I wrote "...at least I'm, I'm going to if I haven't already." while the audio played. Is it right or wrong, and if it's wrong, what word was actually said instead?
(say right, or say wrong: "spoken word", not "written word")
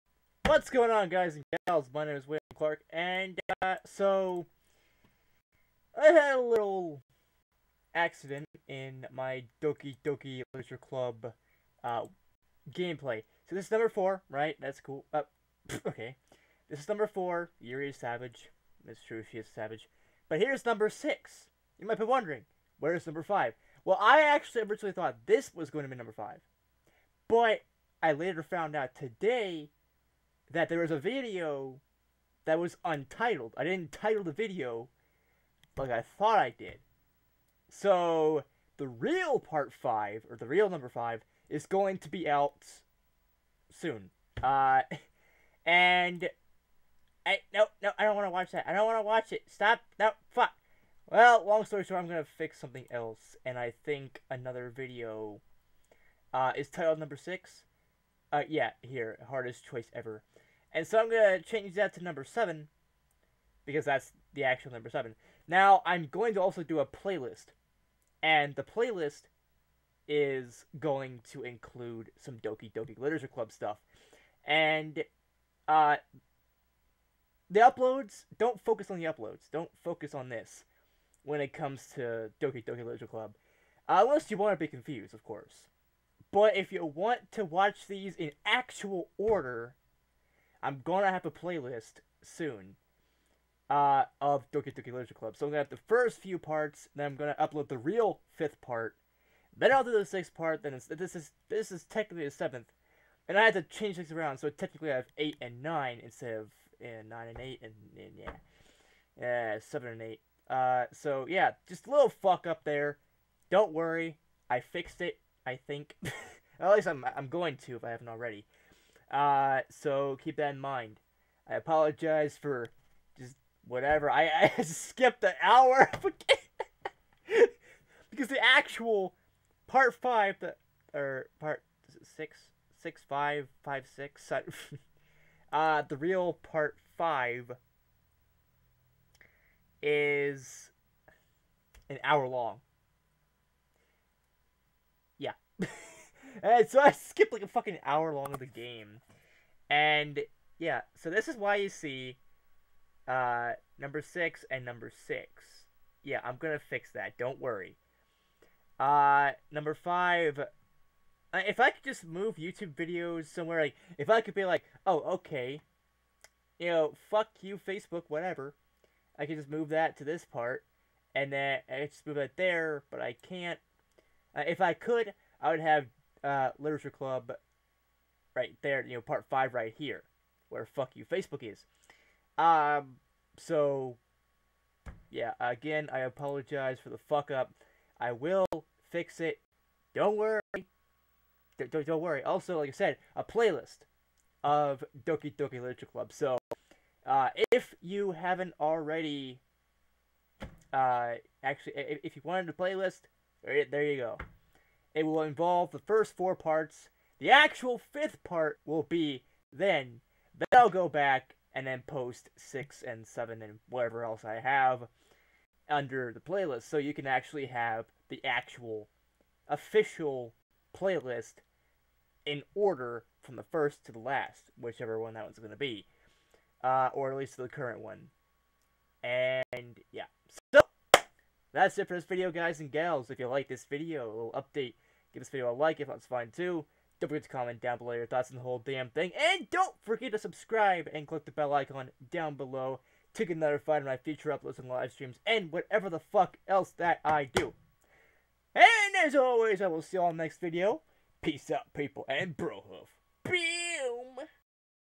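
right.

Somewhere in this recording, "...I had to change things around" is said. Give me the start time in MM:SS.
01:43.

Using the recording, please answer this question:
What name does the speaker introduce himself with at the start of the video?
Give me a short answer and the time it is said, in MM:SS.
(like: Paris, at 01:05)
William Clark, at 00:02.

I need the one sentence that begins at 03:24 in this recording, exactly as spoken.
It will involve the first four parts.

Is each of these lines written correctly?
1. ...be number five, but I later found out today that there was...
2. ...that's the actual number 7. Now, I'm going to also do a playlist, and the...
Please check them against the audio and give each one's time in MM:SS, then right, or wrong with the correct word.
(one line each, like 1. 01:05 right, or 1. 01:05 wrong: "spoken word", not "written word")
1. 00:25 right
2. 01:03 right.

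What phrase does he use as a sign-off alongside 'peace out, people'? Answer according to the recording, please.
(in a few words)
bro hoof.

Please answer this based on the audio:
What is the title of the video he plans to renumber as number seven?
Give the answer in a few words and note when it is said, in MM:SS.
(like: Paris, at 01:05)
hardest choice ever, at 00:59.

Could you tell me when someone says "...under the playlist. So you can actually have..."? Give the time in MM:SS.
03:35.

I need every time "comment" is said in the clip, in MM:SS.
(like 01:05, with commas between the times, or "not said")
03:57.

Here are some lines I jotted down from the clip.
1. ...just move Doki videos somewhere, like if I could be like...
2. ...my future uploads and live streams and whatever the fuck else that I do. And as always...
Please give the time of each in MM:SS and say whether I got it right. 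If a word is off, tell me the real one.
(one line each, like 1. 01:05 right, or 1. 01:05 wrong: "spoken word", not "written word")
1. 02:41 wrong: "YouTube", not "Doki"
2. 04:03 right.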